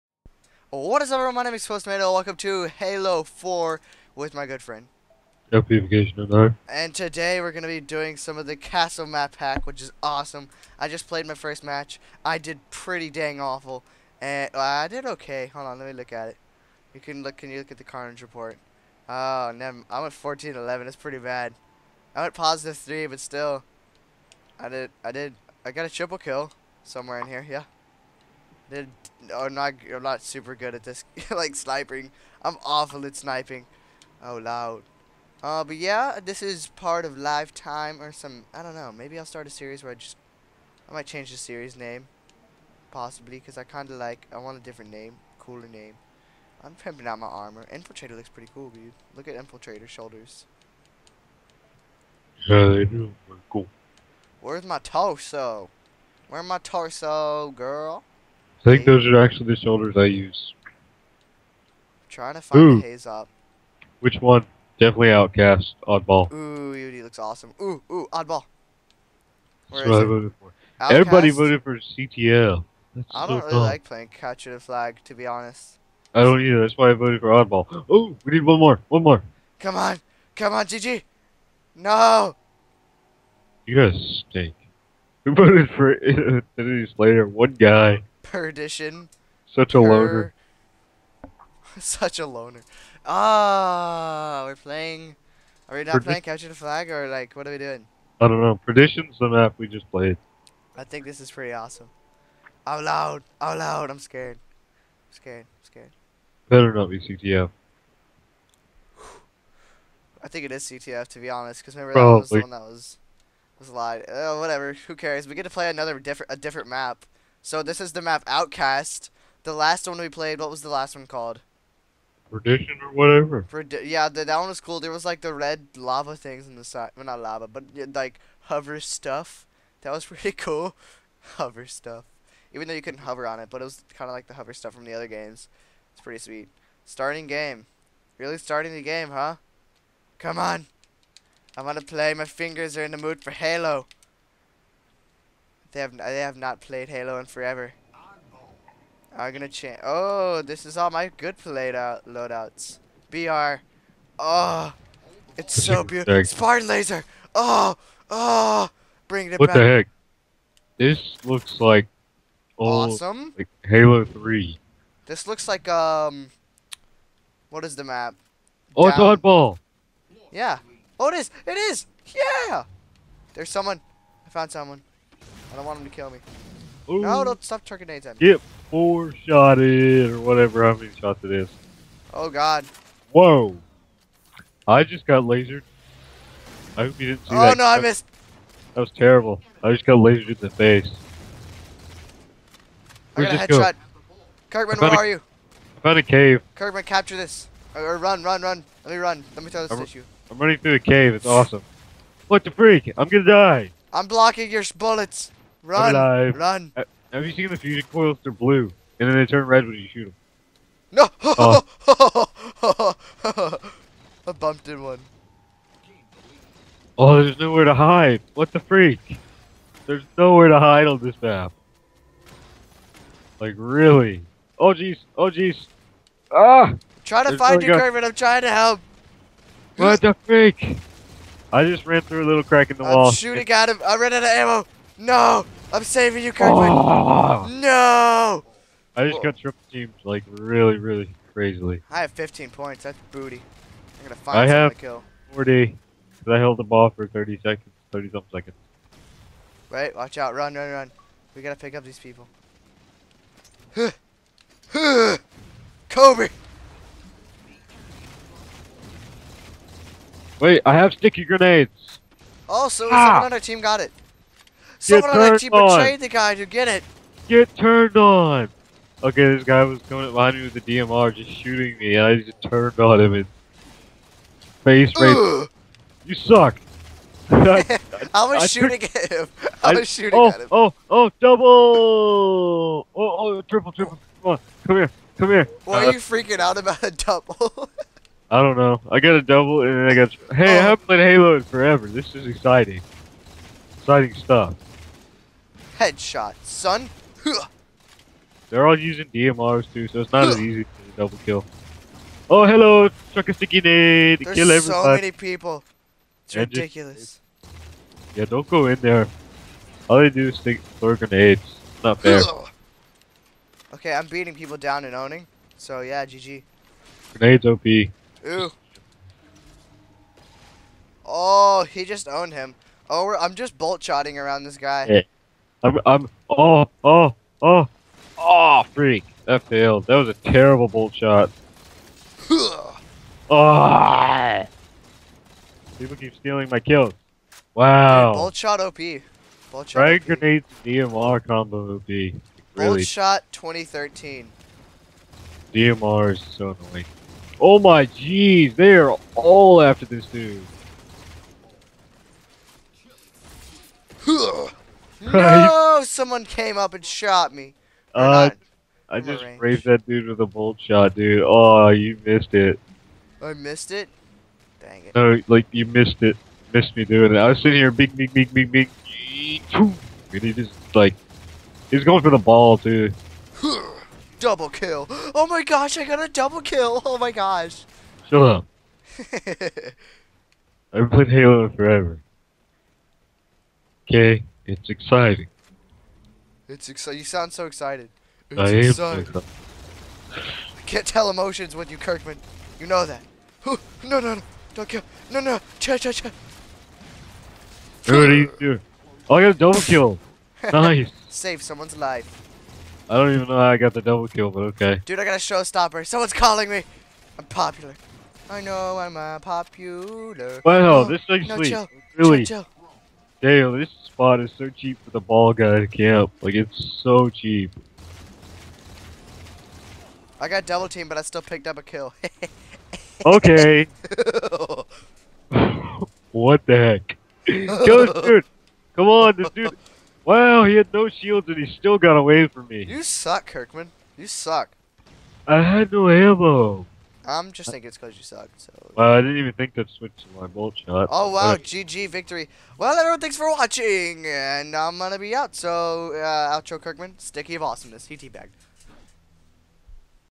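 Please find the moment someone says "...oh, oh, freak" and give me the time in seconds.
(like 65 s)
327 s.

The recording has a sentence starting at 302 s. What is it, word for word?
Oh, hello, truck a sticky nade.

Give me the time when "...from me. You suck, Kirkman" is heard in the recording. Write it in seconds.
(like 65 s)
432 s.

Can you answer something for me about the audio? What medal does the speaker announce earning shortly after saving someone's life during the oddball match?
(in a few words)
showstopper.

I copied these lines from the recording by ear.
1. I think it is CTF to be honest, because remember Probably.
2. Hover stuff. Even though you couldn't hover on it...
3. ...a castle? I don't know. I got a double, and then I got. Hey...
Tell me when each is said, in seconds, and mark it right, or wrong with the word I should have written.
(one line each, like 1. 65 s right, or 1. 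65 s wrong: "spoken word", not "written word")
1. 110 s right
2. 131 s right
3. 286 s wrong: "double", not "castle".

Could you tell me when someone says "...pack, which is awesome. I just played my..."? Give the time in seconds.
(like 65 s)
9 s.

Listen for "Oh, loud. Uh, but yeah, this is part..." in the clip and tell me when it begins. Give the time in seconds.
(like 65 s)
34 s.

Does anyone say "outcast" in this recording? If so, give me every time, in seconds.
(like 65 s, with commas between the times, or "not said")
65 s, 70 s, 118 s.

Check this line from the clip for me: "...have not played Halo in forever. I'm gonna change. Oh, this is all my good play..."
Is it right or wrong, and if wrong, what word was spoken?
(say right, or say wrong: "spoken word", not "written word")
right.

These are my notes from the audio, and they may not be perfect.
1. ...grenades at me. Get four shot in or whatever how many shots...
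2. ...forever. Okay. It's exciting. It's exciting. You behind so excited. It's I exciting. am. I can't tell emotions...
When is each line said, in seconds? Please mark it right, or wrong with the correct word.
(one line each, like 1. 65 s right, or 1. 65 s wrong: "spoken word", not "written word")
1. 177 s right
2. 381 s wrong: "sound", not "behind".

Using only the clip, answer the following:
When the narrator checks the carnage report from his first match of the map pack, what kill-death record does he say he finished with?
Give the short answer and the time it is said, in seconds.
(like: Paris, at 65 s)
14-11, at 20 s.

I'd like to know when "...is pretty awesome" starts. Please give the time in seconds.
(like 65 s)
101 s.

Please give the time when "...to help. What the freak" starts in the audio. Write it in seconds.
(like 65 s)
228 s.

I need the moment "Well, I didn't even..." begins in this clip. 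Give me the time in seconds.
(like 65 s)
438 s.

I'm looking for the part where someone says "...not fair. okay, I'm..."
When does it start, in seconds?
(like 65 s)
311 s.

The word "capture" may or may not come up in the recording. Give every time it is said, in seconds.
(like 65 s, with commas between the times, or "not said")
74 s, 96 s, 196 s.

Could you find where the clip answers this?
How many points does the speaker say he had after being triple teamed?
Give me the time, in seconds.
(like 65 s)
242 s.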